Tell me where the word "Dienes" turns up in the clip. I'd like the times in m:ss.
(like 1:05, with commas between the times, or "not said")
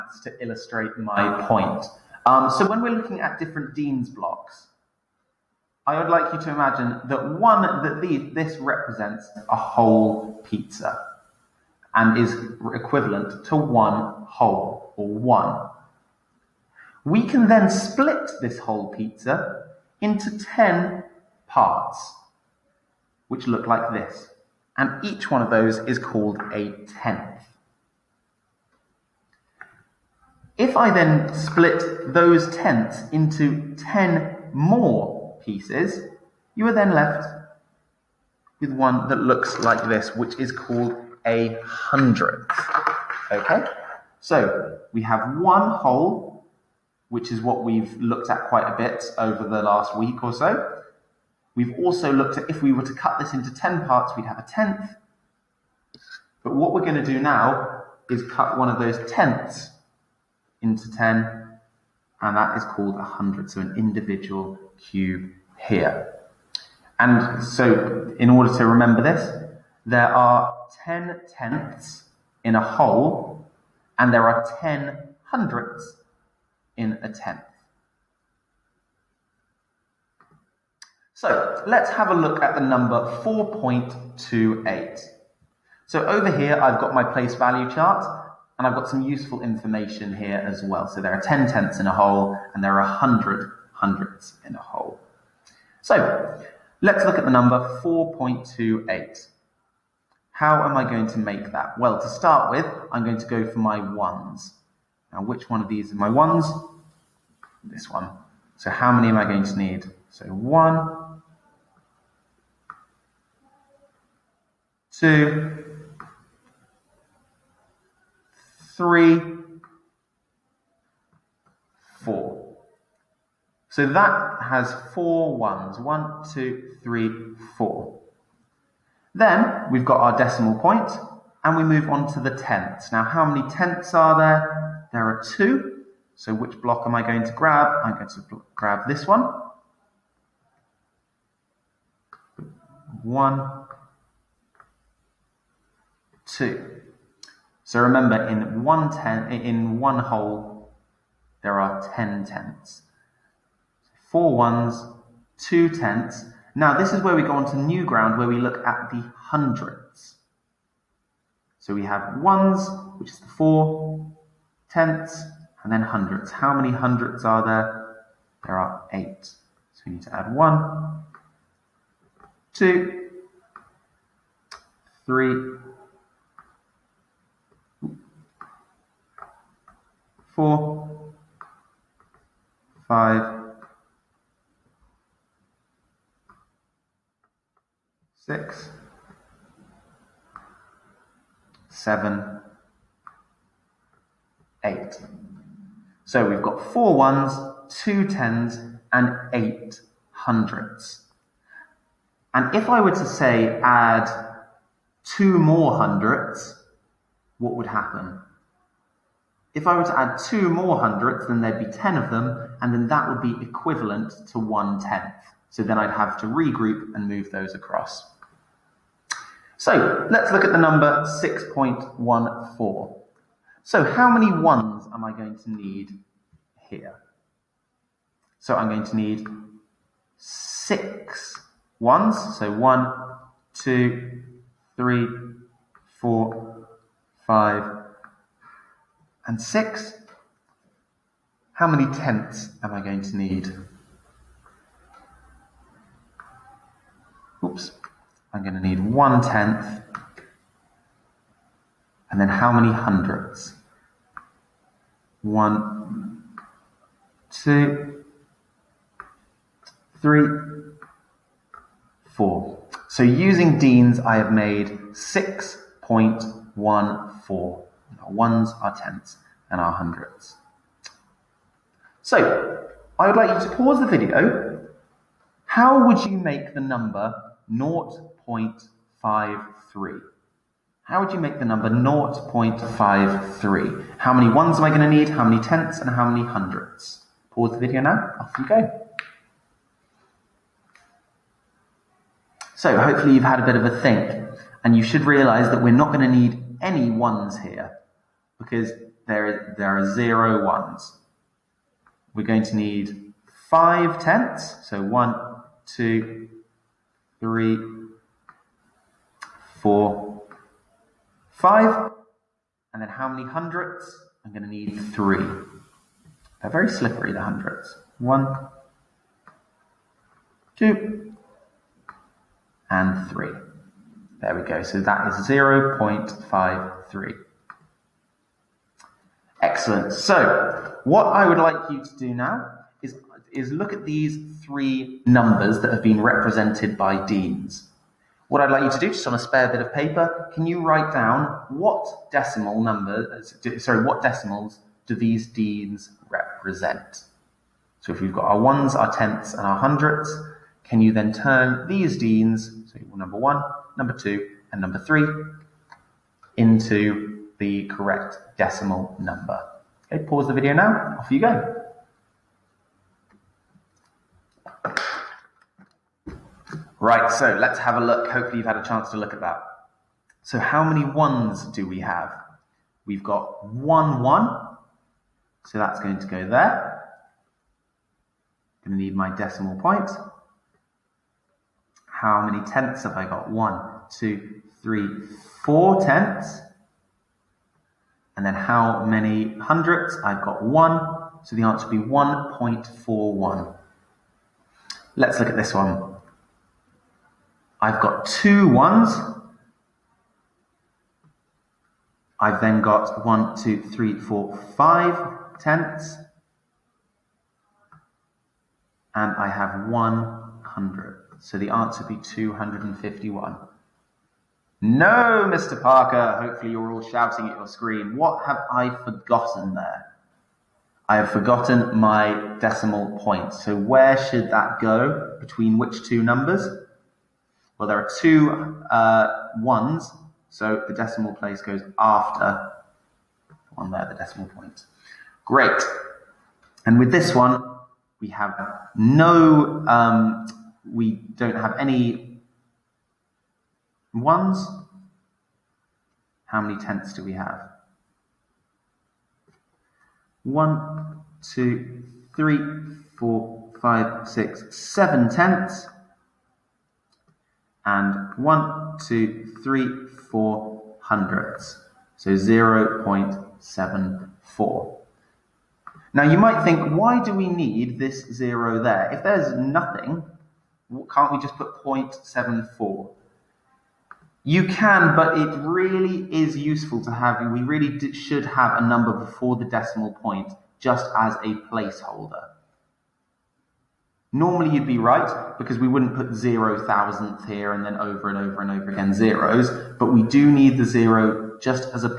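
0:03, 4:23, 5:37, 5:45, 5:51.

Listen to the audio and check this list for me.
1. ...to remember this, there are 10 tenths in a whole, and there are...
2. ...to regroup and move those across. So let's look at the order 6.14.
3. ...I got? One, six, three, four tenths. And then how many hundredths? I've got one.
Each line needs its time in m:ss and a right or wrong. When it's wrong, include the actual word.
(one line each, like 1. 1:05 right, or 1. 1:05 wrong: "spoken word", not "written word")
1. 1:08 right
2. 3:36 wrong: "number", not "order"
3. 6:22 wrong: "two", not "six".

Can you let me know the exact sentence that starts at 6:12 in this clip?
We've got one one, so that's going to go there.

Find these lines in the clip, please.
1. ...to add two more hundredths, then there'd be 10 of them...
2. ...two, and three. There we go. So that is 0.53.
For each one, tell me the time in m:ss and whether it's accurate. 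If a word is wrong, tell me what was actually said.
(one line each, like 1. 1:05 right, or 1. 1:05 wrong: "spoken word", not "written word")
1. 3:29 right
2. 5:20 right.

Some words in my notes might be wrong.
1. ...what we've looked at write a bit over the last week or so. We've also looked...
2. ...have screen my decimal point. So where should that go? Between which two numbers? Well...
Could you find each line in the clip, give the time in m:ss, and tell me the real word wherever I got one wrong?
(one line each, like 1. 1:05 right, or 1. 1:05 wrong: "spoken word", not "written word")
1. 0:47 wrong: "quite", not "write"
2. 7:00 wrong: "forgotten", not "screen".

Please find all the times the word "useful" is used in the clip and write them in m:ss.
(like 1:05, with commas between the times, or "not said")
1:29, 7:56.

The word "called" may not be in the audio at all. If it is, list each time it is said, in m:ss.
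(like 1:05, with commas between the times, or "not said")
0:25, 0:40, 1:02.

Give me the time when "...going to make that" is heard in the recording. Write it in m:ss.
1:40.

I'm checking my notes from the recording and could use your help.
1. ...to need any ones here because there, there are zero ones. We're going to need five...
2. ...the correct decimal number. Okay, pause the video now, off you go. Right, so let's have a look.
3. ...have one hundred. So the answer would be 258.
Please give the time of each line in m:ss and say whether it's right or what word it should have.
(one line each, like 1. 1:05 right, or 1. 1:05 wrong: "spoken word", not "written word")
1. 4:56 right
2. 5:57 right
3. 6:49 wrong: "251", not "258".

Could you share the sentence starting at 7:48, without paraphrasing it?
If there's nothing, can't we just put 0.74?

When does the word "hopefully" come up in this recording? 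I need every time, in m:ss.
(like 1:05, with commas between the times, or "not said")
4:52, 6:08, 6:56.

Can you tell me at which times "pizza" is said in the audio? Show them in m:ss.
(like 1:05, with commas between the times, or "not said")
0:10, 0:18.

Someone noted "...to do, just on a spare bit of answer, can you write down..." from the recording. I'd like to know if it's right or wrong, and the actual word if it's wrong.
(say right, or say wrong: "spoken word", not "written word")
wrong: "paper", not "answer".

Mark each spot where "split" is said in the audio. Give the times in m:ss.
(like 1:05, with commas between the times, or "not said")
0:17, 0:31.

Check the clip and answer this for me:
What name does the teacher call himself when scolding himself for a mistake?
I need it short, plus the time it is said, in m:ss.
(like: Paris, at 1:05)
Mr. Parker, at 6:55.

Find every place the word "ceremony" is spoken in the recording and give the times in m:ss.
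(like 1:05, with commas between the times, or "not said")
not said.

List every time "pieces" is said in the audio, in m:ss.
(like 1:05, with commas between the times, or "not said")
0:35.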